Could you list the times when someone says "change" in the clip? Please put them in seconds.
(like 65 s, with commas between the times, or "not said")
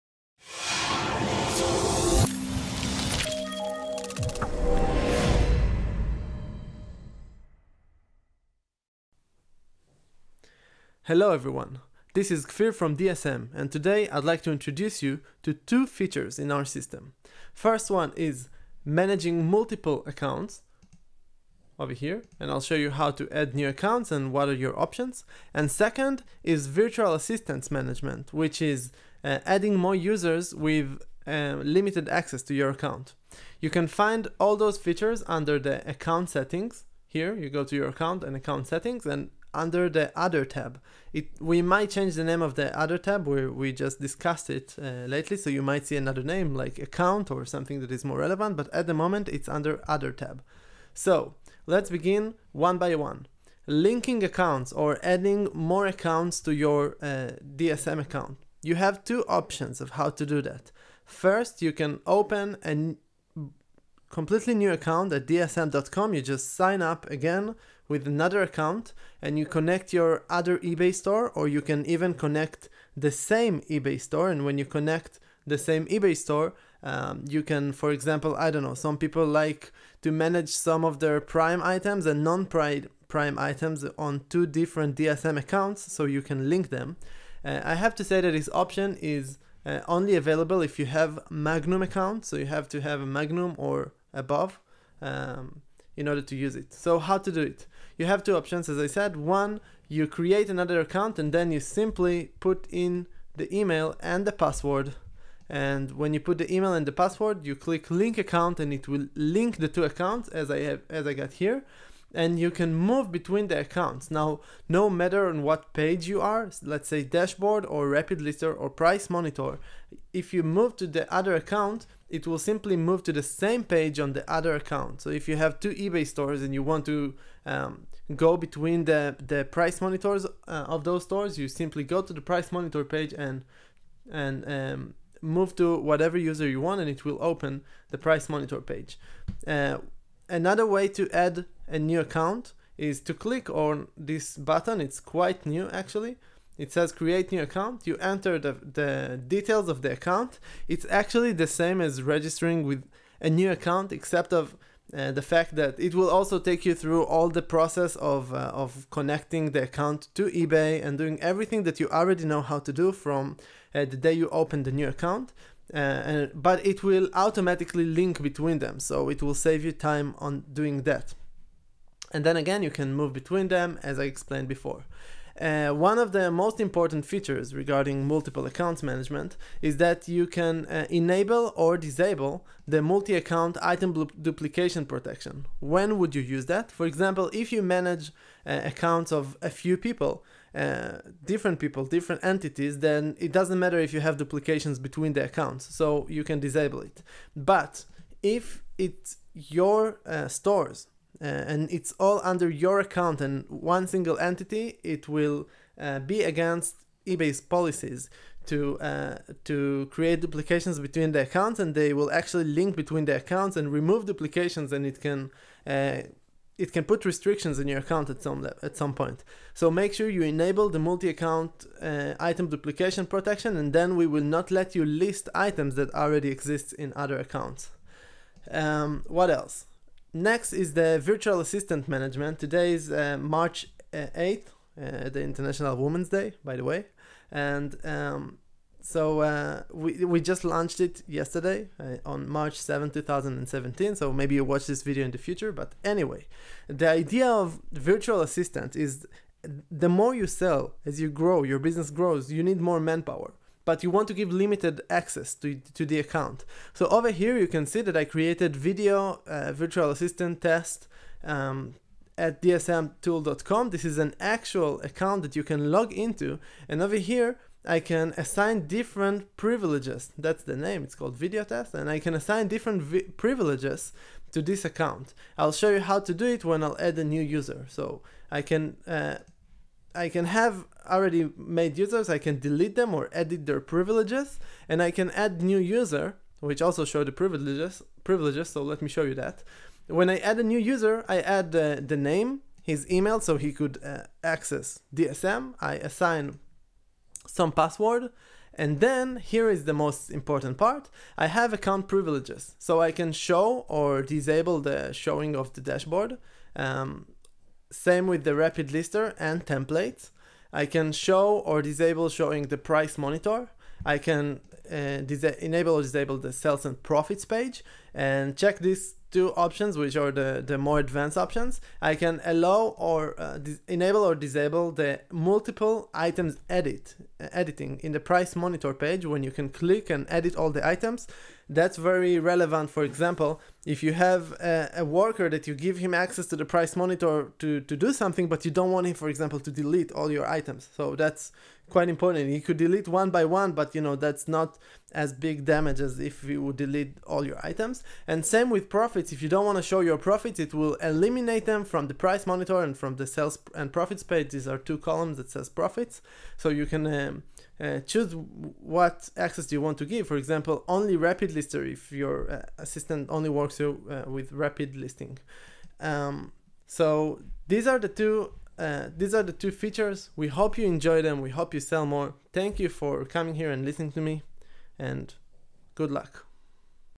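41 s.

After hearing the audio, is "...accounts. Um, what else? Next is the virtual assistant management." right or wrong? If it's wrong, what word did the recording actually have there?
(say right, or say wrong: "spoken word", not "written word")
right.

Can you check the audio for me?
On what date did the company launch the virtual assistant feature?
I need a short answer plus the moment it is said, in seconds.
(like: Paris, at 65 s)
March 7, 2017, at 242 s.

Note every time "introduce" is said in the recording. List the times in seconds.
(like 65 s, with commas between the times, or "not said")
14 s.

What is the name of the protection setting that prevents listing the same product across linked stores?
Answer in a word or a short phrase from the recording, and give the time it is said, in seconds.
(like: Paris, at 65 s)
Multi-account item duplication protection, at 182 s.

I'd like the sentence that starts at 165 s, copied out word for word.
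Uh, and, but it will automatically link between them, so it will save you time on doing that.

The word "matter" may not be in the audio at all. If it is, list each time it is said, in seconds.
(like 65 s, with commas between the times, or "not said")
114 s, 193 s.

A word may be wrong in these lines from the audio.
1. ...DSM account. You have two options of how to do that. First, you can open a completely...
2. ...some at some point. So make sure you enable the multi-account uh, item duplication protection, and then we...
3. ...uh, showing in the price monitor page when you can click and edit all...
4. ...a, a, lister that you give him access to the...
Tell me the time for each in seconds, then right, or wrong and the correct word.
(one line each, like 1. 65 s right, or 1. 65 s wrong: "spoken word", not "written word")
1. 57 s right
2. 218 s right
3. 327 s wrong: "editing", not "showing"
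4. 334 s wrong: "worker", not "lister".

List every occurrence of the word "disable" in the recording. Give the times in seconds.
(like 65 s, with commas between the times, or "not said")
181 s, 196 s, 304 s, 311 s, 315 s, 324 s.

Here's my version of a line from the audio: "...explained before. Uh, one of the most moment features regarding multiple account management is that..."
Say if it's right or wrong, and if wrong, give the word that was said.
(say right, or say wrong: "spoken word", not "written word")
wrong: "important", not "moment".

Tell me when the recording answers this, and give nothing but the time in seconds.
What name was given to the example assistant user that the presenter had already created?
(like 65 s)
271 s.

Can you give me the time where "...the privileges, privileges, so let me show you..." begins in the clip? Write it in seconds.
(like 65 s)
287 s.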